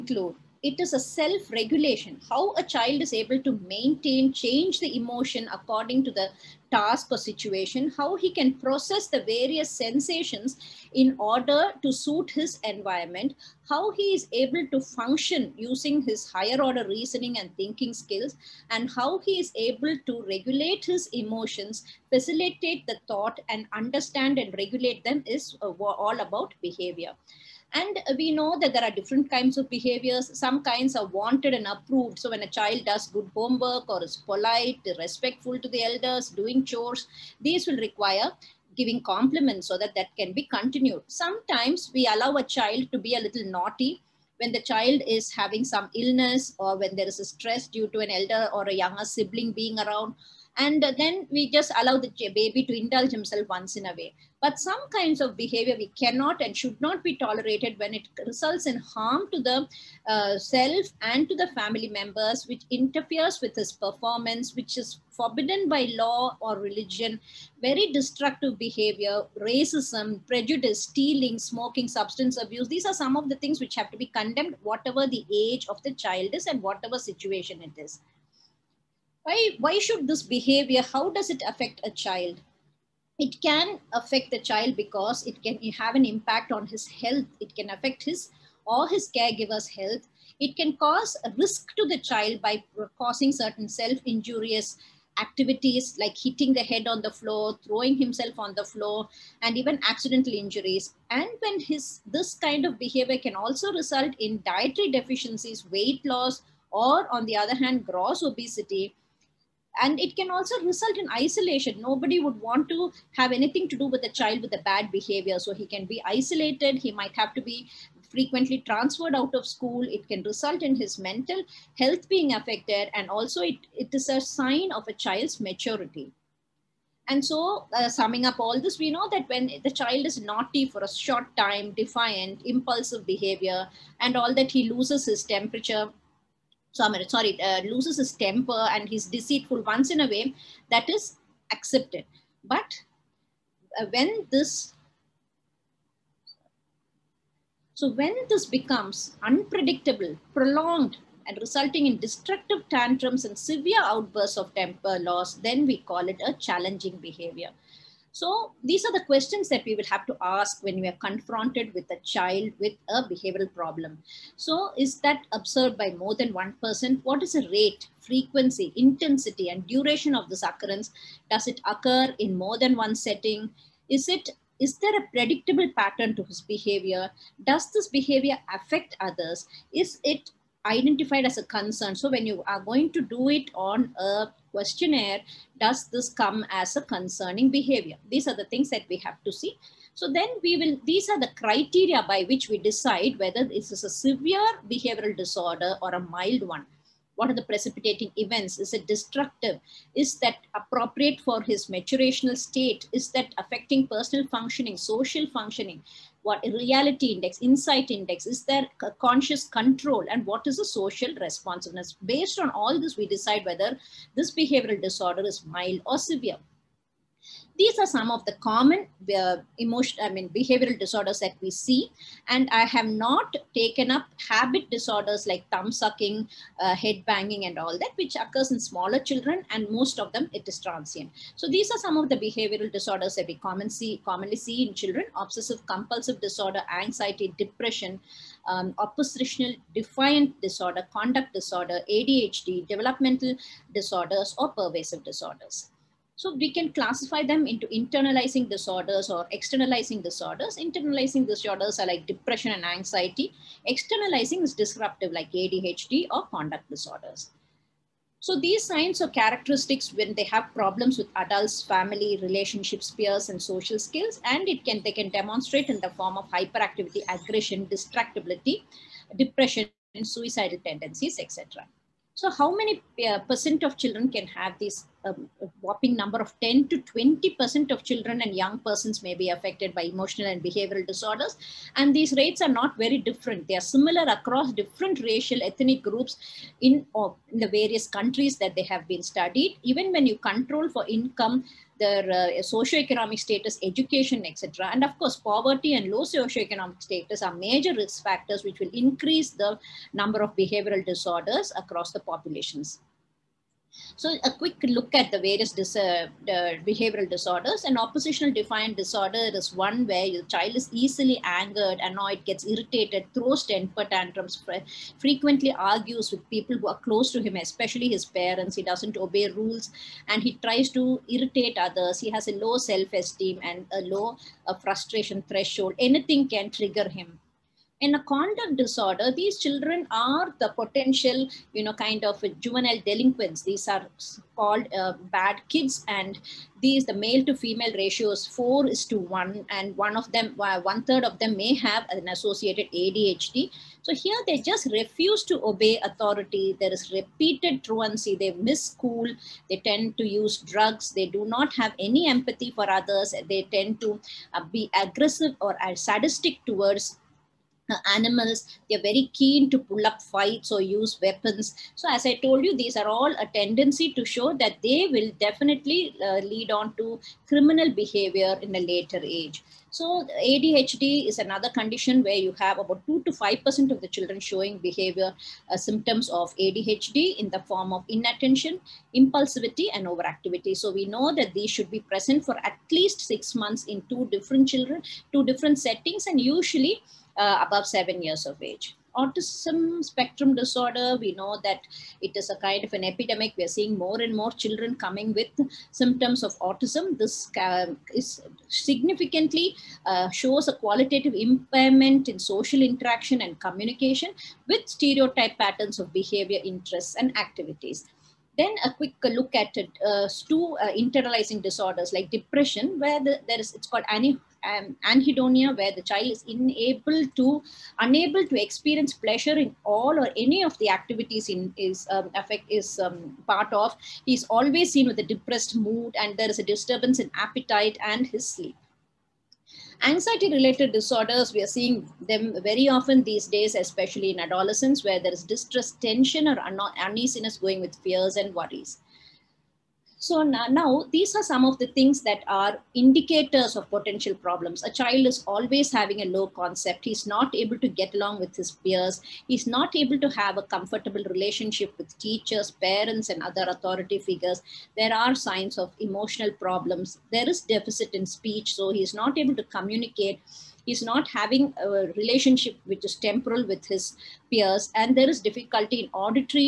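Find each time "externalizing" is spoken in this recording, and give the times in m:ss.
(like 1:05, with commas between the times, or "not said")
4:09, 4:13.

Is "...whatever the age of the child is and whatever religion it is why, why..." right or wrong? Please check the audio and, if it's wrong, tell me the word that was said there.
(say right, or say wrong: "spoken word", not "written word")
wrong: "situation", not "religion".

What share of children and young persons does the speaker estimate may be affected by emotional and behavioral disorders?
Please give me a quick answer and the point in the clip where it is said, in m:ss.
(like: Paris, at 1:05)
10 to 20%, at 4:36.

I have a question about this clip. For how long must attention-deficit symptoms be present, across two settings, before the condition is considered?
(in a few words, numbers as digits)
six months.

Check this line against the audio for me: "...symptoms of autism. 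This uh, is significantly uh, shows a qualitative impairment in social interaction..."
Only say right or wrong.
right.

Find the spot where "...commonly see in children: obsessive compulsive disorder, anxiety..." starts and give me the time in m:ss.
3:54.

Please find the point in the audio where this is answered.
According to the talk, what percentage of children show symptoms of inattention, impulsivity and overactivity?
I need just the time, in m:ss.
6:12.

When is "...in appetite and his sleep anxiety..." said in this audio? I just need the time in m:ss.
7:06.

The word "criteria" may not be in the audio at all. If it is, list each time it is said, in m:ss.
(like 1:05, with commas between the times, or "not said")
3:11.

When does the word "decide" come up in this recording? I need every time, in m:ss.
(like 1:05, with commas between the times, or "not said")
3:12, 3:33.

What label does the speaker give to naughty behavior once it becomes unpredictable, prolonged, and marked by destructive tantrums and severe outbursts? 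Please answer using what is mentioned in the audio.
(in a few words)
challenging behavior.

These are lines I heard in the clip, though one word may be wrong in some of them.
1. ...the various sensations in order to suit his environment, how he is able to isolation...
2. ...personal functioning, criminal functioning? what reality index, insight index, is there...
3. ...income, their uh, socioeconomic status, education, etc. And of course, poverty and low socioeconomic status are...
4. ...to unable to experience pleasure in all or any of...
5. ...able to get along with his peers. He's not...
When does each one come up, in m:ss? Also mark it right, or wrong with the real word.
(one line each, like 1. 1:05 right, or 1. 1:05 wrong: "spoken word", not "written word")
1. 0:09 wrong: "function", not "isolation"
2. 3:23 wrong: "social", not "criminal"
3. 4:50 right
4. 6:57 right
5. 7:27 right.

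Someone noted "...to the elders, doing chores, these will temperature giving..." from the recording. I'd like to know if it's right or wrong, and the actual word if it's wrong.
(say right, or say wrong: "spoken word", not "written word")
wrong: "require", not "temperature".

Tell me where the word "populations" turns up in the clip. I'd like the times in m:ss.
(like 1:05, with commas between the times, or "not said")
5:02.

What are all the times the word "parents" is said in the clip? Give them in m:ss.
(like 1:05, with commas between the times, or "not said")
5:18, 7:32.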